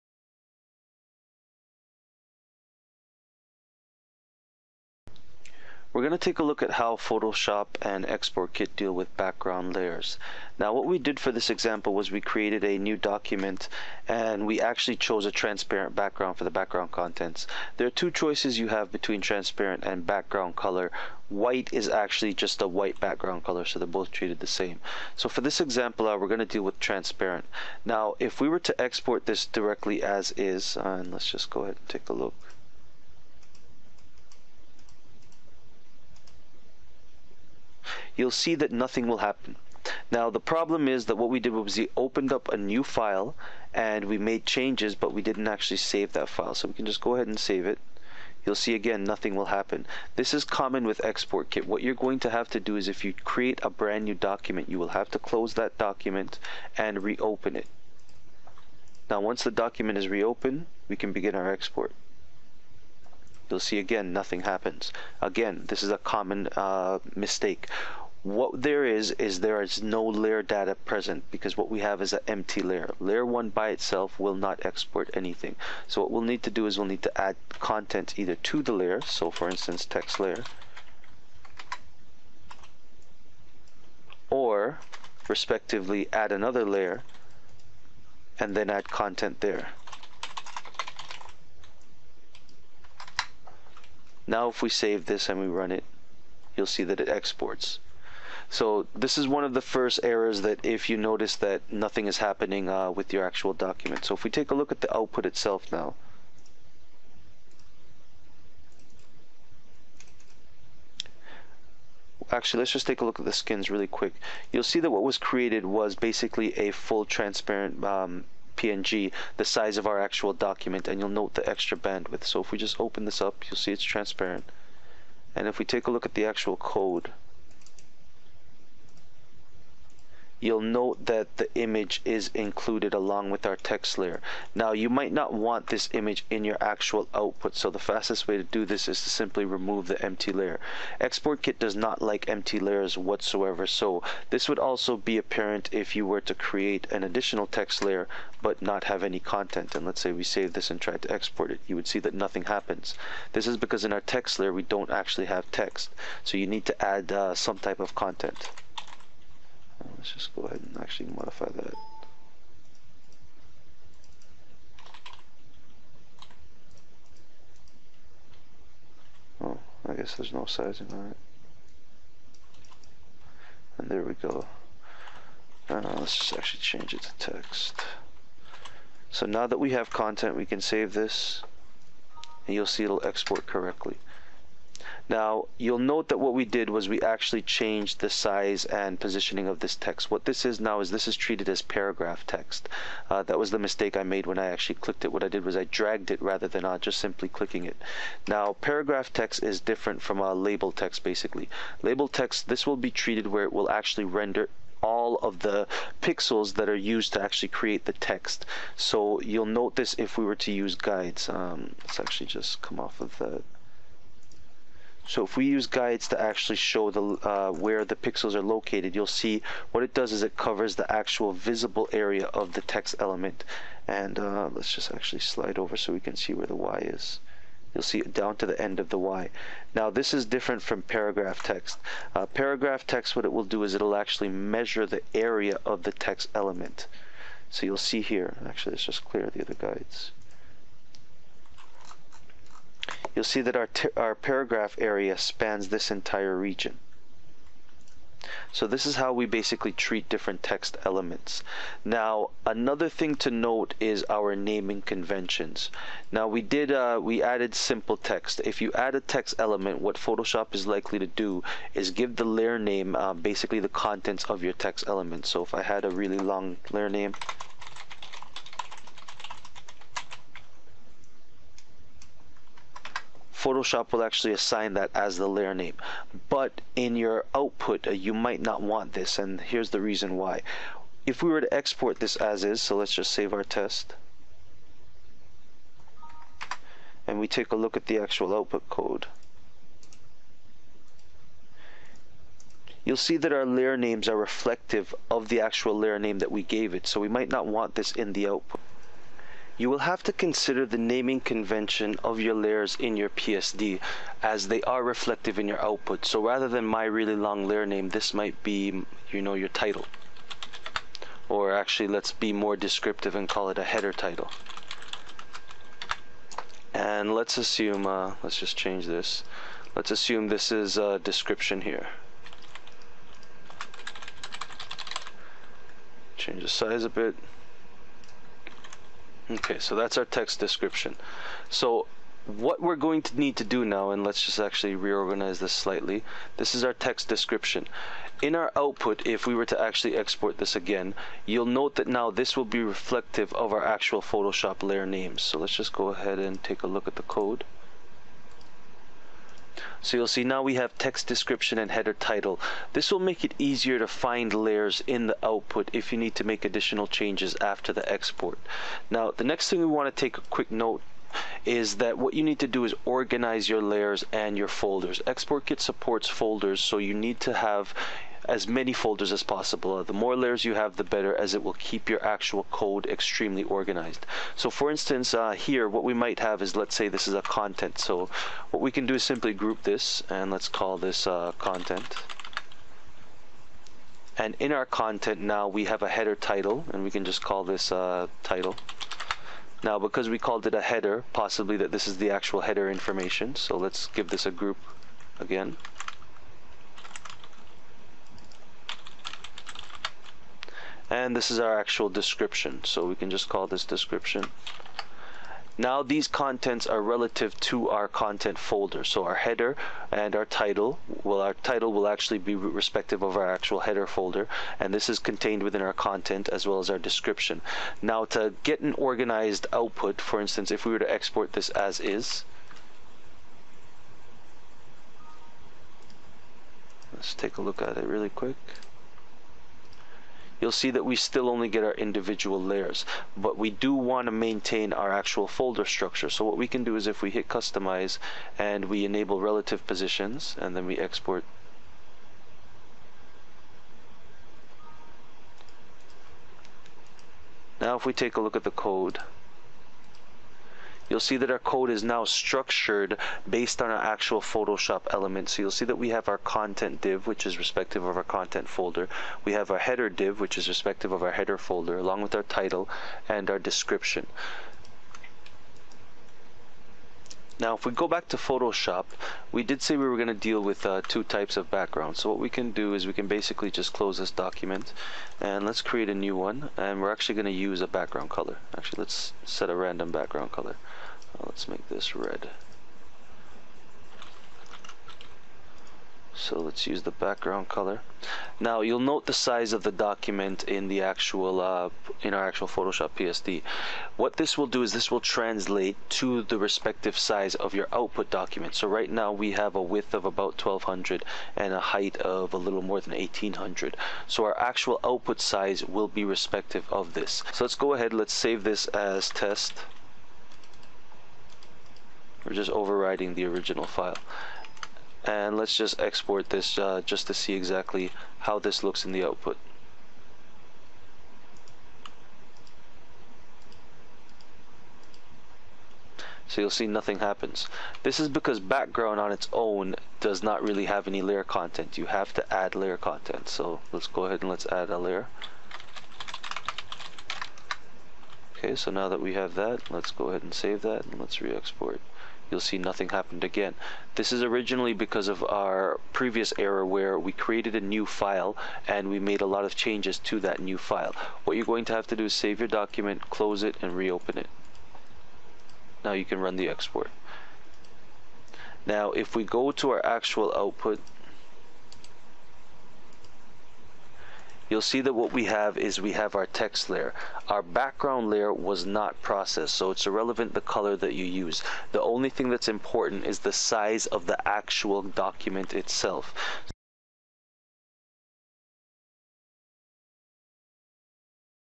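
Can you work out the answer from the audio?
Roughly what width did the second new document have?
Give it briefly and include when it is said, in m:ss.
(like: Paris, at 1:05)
About 1200, at 8:20.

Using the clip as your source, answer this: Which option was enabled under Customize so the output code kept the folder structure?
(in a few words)
Relative positions.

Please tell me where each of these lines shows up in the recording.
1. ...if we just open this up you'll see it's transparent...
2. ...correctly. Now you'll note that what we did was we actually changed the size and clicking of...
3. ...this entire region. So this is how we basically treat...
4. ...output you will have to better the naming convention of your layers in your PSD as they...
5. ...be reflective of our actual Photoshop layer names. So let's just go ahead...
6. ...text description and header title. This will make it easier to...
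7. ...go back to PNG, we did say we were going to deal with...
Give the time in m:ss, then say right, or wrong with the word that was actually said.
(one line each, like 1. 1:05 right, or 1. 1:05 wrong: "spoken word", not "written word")
1. 2:02 right
2. 3:03 wrong: "positioning", not "clicking"
3. 4:05 right
4. 4:58 wrong: "consider", not "better"
5. 5:42 right
6. 5:50 right
7. 7:47 wrong: "Photoshop", not "PNG".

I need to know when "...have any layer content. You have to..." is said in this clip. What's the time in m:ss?
8:50.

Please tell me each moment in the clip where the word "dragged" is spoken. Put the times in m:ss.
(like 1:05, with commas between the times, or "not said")
3:15.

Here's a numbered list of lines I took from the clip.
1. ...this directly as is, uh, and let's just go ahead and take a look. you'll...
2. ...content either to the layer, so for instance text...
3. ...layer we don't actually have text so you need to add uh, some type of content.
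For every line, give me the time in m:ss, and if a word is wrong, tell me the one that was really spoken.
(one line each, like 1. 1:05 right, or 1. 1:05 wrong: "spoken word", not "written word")
1. 0:29 right
2. 1:17 right
3. 2:34 right.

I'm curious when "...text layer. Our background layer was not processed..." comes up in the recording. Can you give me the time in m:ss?
9:26.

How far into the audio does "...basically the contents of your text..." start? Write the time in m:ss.
4:23.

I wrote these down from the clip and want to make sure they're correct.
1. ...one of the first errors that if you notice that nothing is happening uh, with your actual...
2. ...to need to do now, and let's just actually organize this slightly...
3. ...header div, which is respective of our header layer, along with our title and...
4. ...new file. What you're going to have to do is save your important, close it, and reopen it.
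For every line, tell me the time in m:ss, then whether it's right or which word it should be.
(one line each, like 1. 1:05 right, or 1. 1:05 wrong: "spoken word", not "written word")
1. 1:39 right
2. 5:33 wrong: "reorganize", not "organize"
3. 7:39 wrong: "folder", not "layer"
4. 9:10 wrong: "document", not "important".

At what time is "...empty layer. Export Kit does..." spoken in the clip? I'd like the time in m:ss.
2:20.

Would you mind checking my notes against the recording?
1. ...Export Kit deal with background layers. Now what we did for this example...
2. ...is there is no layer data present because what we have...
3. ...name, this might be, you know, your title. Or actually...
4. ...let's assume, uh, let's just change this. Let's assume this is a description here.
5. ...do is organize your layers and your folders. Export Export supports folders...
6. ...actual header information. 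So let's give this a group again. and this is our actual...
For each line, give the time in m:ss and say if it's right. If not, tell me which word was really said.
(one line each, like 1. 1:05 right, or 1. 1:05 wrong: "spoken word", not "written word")
1. 0:08 right
2. 1:09 right
3. 5:07 right
4. 5:17 right
5. 6:02 wrong: "Kit", not "Export"
6. 6:32 right.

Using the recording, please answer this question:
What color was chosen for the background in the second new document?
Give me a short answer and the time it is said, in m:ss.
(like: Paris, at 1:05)
Red, at 8:01.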